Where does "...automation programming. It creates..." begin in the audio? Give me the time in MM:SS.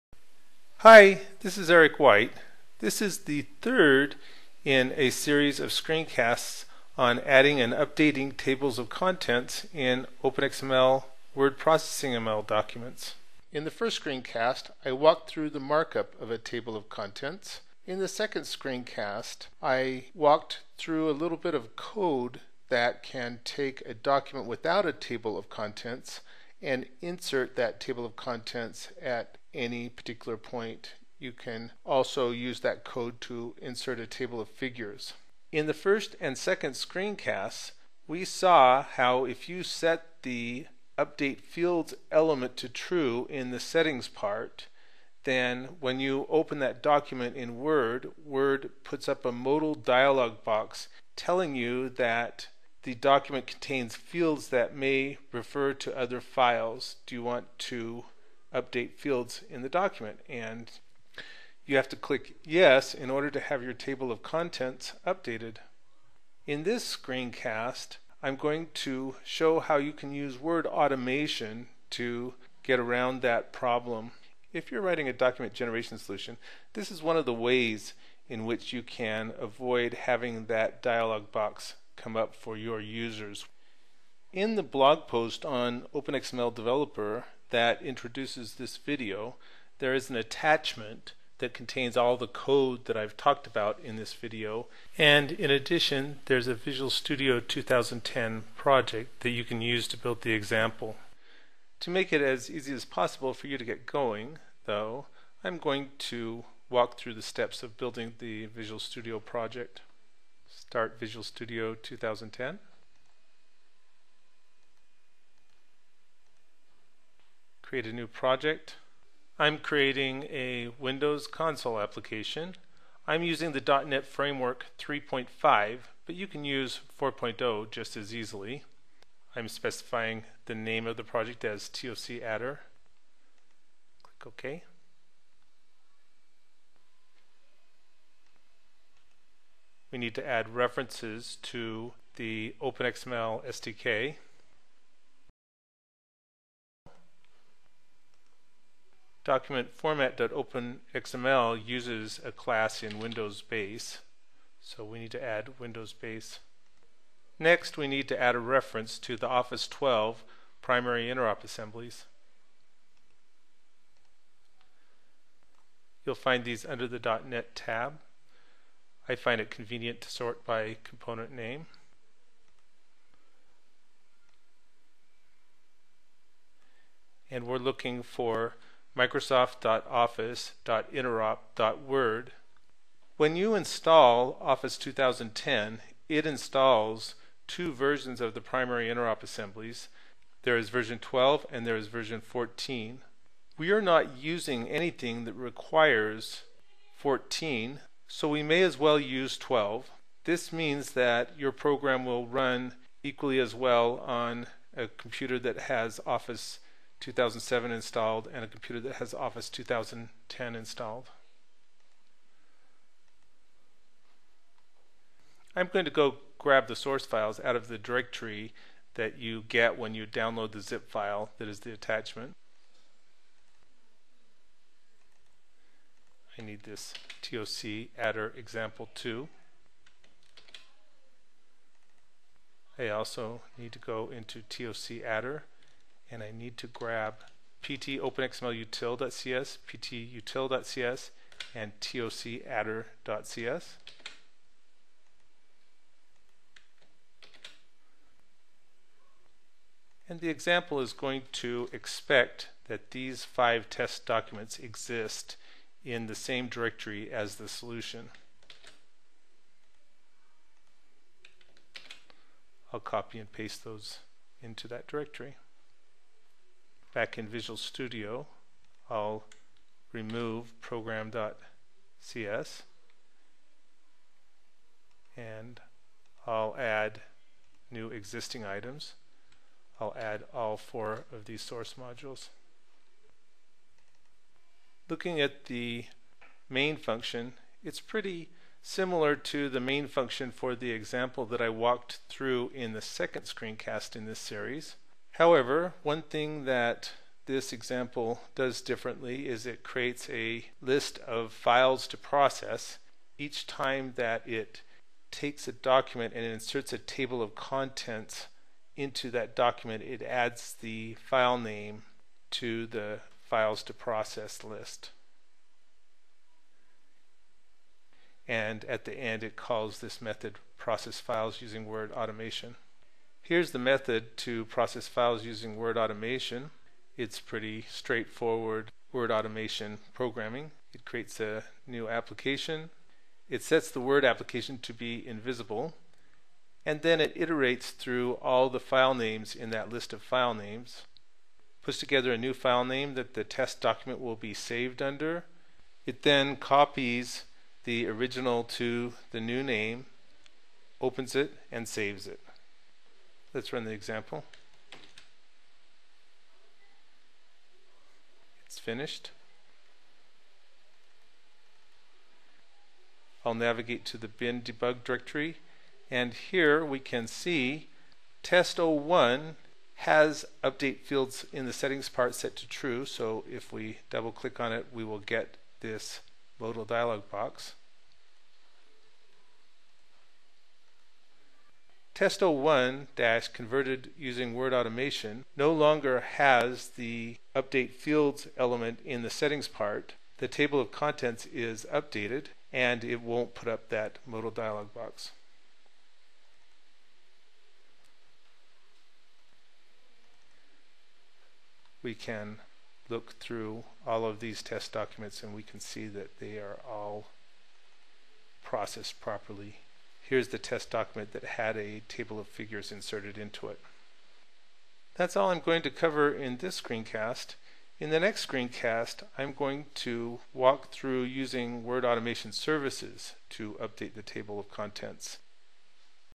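05:29.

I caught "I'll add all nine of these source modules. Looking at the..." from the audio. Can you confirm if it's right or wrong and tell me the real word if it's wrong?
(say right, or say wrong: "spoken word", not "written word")
wrong: "four", not "nine".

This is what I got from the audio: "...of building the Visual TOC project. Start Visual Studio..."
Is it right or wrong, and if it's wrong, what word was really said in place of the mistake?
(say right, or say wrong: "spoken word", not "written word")
wrong: "Studio", not "TOC".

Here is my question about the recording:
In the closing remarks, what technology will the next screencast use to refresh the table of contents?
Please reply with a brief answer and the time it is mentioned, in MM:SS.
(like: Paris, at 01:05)
Word Automation Services, at 07:01.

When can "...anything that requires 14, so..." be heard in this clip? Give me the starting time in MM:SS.
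03:14.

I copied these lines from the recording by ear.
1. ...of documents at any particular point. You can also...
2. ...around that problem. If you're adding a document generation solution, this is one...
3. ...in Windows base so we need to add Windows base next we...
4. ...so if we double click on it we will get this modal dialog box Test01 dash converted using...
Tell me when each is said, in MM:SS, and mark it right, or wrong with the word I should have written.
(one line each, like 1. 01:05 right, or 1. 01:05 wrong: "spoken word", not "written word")
1. 00:28 wrong: "contents", not "documents"
2. 01:12 wrong: "writing", not "adding"
3. 02:32 right
4. 06:12 right.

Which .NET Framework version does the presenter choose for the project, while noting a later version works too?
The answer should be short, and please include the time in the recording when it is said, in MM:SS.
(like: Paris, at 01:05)
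3.5, at 02:04.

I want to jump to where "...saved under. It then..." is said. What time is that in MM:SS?
05:44.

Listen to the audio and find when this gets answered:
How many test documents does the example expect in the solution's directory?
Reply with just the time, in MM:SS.
04:13.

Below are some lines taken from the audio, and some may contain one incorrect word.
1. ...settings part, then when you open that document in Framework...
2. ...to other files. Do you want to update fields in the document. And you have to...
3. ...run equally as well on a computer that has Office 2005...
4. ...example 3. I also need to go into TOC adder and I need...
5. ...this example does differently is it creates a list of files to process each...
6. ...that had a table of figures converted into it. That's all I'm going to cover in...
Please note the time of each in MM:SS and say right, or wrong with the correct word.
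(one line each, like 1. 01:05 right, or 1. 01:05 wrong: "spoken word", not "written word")
1. 00:43 wrong: "Word", not "Framework"
2. 00:55 right
3. 03:22 wrong: "2007", not "2005"
4. 03:48 wrong: "2", not "3"
5. 04:57 right
6. 06:51 wrong: "inserted", not "converted".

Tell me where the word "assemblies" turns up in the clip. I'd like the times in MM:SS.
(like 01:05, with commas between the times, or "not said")
02:41, 03:09.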